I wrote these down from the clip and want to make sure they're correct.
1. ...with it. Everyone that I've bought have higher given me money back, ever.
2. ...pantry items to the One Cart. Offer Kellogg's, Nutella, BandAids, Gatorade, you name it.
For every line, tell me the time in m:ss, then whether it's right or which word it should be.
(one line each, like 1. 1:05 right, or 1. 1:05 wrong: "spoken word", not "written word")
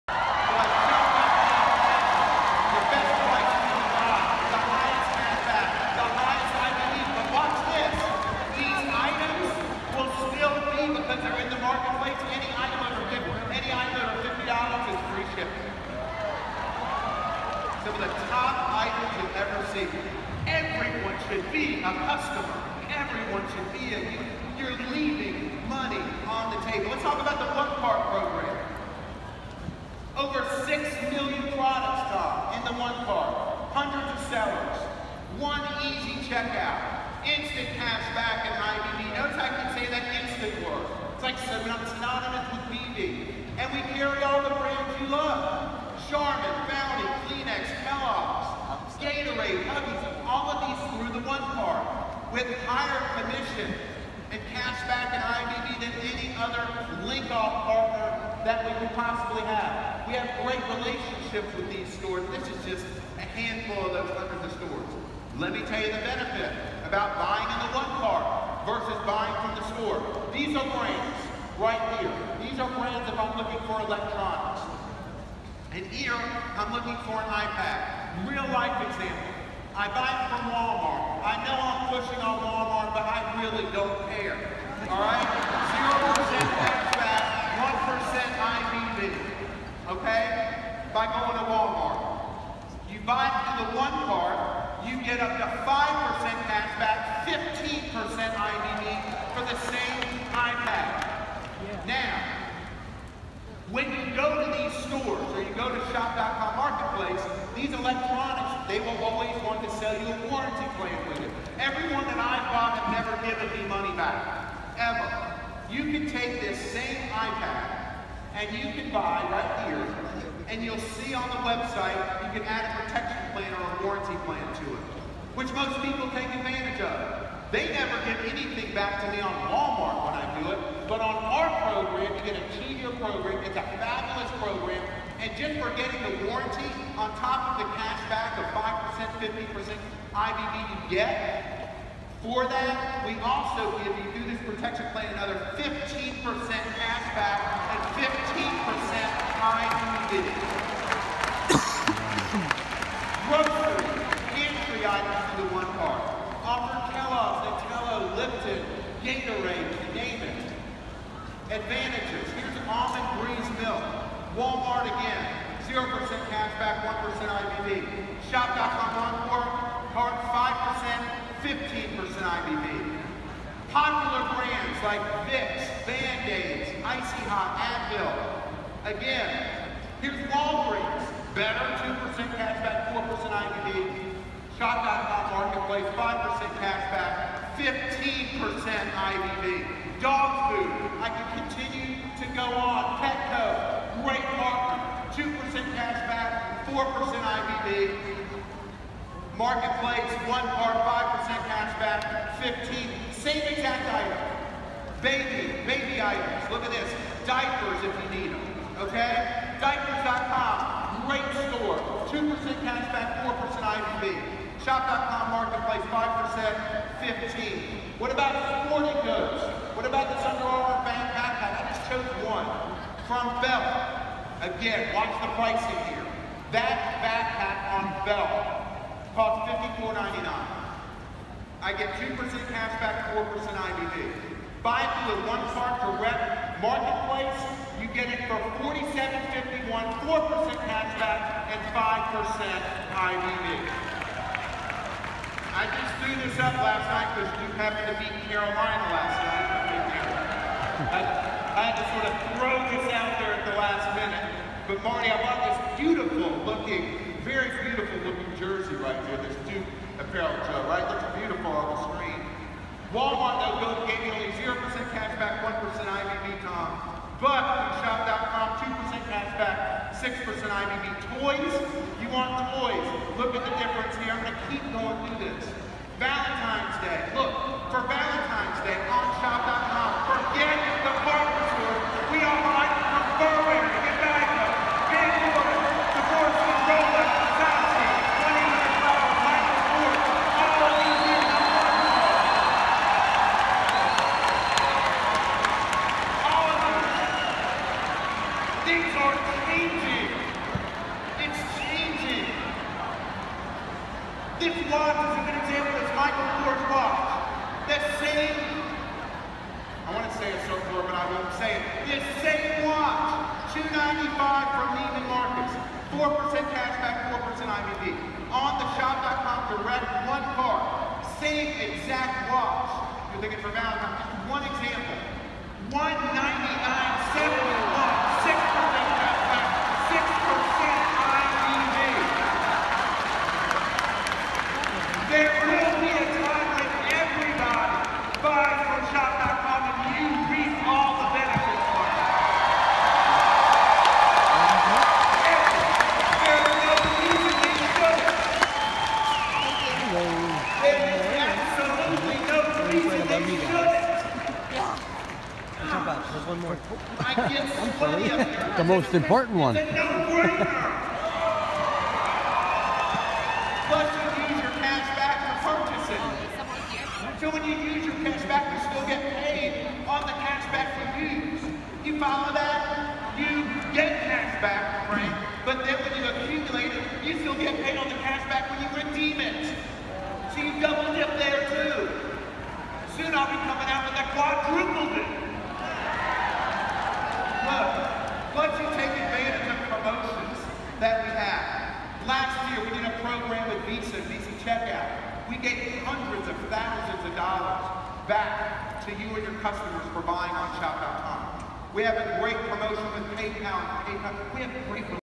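1. 1:51 wrong: "never", not "higher"
2. 2:34 wrong: "Lipton", not "BandAids".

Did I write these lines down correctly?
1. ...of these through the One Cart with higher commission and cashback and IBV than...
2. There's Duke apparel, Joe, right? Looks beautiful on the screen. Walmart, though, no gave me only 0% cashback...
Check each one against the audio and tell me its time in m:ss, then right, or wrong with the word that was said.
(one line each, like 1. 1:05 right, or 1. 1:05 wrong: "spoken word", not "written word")
1. 0:50 right
2. 4:19 right.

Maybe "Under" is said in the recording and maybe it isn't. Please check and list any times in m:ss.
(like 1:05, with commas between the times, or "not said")
3:40.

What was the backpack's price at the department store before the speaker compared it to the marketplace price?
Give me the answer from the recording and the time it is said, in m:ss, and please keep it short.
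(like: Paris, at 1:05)
$54.99, at 3:49.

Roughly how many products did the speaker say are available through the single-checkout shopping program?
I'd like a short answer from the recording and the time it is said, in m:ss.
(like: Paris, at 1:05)
Over 6 million, at 0:30.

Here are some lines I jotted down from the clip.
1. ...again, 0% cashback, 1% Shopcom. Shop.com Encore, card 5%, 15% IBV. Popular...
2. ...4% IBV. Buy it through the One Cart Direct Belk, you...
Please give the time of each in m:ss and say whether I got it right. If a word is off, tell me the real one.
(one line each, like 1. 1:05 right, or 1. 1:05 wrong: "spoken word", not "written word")
1. 2:44 wrong: "IBV", not "Shopcom"
2. 3:53 wrong: "Marketplace", not "Belk".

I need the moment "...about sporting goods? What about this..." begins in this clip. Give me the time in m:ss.
3:38.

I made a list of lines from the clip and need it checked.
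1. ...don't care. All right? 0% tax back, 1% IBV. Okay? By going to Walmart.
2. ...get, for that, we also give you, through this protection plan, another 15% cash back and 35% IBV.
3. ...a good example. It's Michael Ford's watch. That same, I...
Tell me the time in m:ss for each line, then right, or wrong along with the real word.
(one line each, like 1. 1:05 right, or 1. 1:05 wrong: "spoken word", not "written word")
1. 1:23 right
2. 2:20 wrong: "15", not "35"
3. 5:05 right.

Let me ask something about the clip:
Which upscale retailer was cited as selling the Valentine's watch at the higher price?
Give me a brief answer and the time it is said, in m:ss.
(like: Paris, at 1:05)
Neiman Marcus, at 5:14.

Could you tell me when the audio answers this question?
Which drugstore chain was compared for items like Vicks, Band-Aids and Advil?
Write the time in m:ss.
3:00.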